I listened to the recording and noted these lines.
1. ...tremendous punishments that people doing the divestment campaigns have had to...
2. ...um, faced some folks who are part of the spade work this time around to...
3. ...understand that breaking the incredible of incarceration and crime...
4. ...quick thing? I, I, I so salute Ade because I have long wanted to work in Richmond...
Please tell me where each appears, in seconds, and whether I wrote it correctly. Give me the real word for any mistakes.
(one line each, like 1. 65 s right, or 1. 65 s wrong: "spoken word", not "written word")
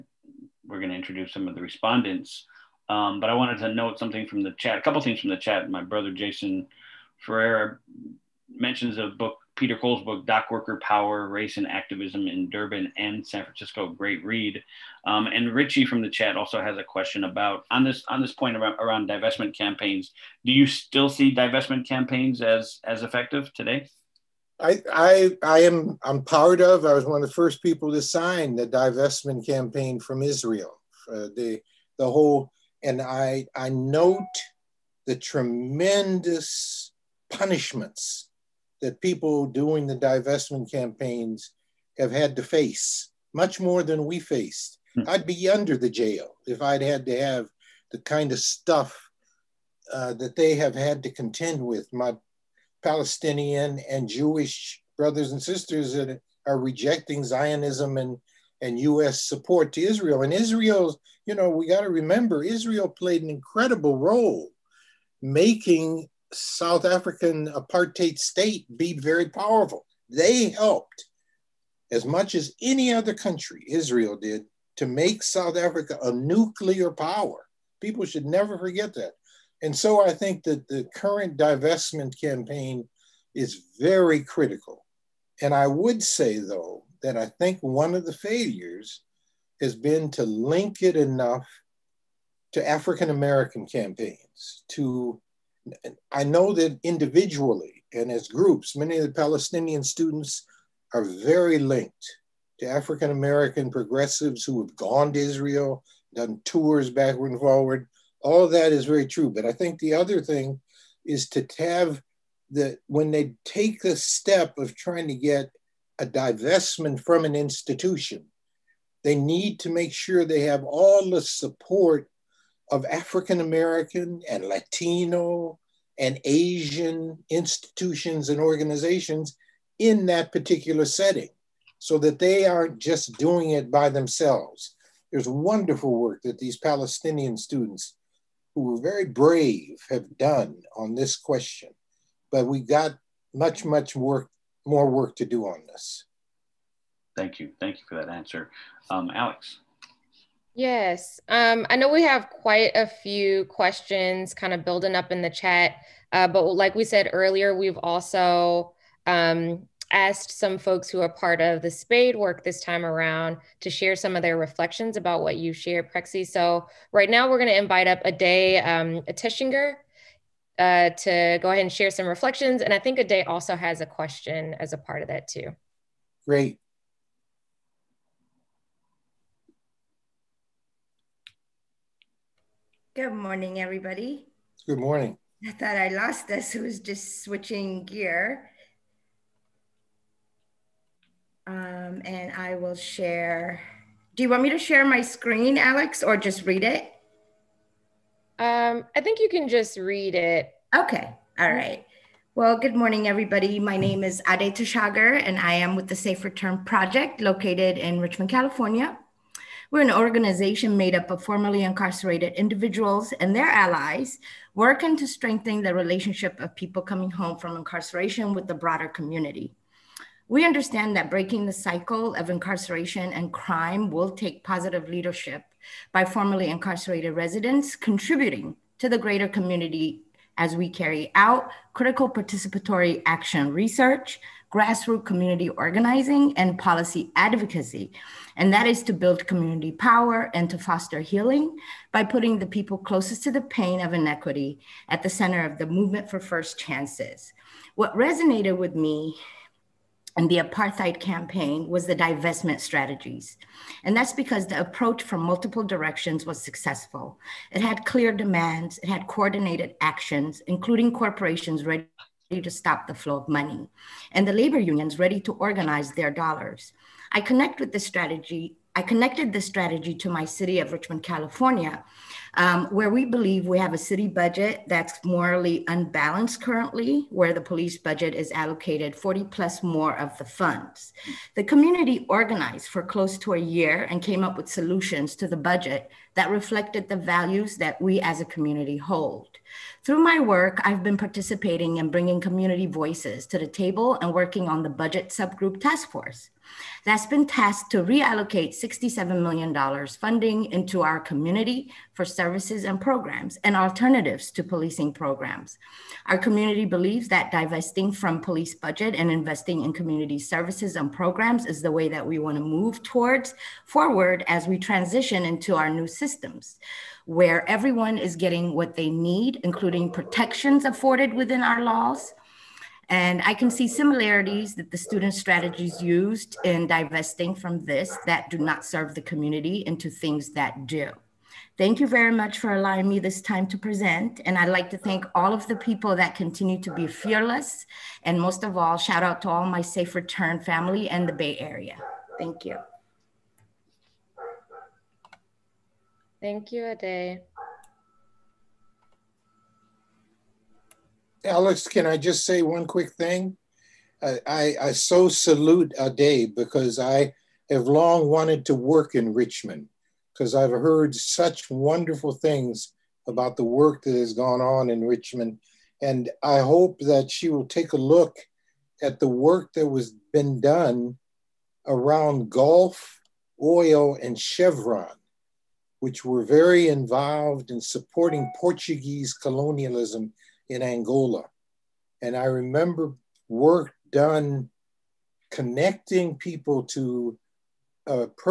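1. 35 s right
2. 159 s wrong: "asked", not "faced"
3. 220 s wrong: "cycle", not "incredible"
4. 352 s right.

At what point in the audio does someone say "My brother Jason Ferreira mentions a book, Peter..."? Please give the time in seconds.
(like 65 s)
5 s.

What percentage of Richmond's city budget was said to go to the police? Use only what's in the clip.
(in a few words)
40 plus.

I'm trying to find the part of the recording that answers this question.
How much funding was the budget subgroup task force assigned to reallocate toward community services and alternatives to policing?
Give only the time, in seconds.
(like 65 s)
298 s.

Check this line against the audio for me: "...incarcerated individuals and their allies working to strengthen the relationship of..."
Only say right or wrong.
right.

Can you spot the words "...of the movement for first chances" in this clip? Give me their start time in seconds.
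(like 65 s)
245 s.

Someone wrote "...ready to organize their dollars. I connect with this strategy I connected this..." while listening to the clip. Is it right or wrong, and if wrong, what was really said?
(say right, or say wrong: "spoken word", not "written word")
right.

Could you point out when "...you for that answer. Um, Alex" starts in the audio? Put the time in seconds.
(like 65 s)
147 s.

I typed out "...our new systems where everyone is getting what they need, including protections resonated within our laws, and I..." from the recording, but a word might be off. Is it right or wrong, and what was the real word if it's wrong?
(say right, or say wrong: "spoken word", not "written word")
wrong: "afforded", not "resonated".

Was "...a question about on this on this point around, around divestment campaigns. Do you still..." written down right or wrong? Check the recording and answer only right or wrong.
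right.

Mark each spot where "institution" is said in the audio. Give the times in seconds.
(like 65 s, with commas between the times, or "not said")
117 s, 127 s.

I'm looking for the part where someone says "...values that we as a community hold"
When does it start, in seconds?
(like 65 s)
286 s.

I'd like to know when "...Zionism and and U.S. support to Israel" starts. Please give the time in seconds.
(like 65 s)
57 s.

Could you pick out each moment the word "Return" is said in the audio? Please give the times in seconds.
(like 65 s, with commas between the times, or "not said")
206 s, 339 s.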